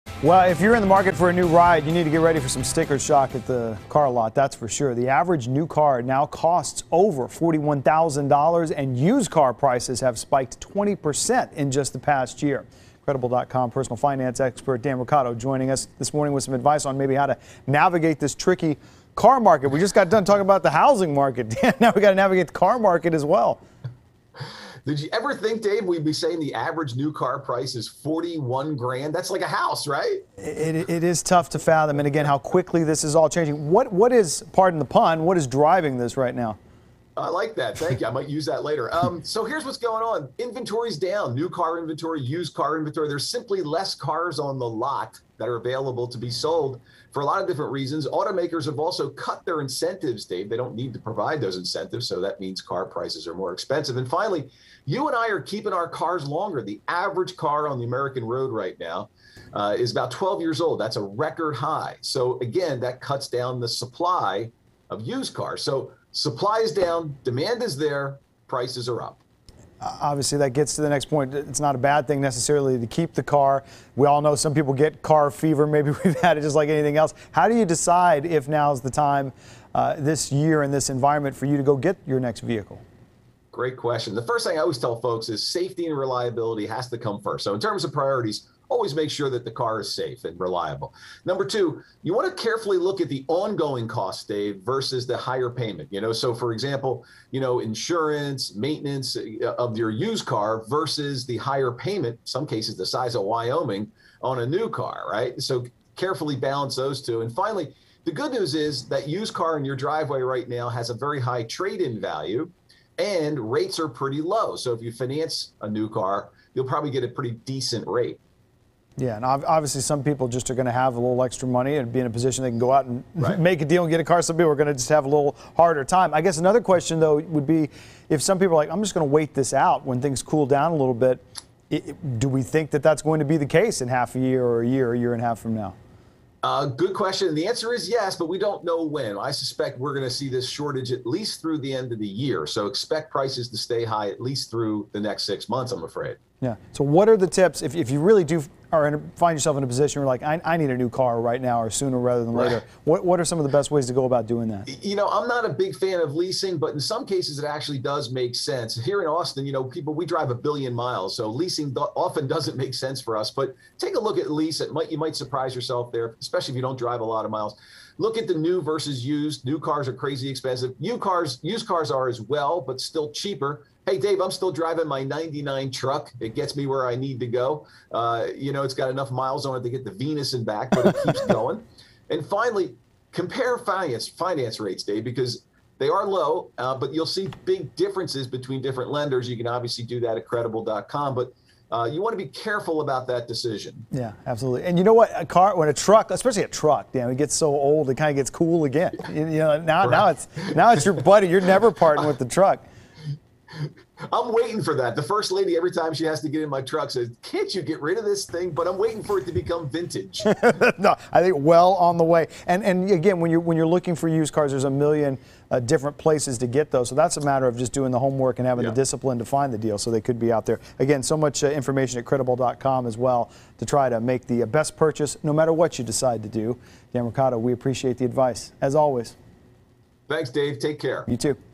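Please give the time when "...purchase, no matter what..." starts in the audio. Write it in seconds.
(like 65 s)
224 s.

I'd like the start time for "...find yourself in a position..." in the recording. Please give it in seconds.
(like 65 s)
149 s.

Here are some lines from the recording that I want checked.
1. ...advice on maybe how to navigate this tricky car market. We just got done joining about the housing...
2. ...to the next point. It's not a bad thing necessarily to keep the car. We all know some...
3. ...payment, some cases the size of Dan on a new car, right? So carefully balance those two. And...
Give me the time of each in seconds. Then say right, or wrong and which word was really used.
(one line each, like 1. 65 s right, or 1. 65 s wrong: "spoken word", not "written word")
1. 16 s wrong: "talking", not "joining"
2. 70 s right
3. 101 s wrong: "Wyoming", not "Dan".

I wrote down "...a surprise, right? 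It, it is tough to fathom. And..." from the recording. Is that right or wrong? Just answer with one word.
wrong.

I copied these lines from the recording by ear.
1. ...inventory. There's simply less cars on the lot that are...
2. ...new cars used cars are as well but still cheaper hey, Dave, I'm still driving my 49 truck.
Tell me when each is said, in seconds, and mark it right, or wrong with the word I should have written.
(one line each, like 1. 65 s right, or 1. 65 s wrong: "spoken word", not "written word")
1. 42 s right
2. 170 s wrong: "99", not "49".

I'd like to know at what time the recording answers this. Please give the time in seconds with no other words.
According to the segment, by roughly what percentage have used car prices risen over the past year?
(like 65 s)
10 s.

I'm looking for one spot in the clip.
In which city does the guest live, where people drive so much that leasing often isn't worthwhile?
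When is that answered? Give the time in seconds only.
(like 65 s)
159 s.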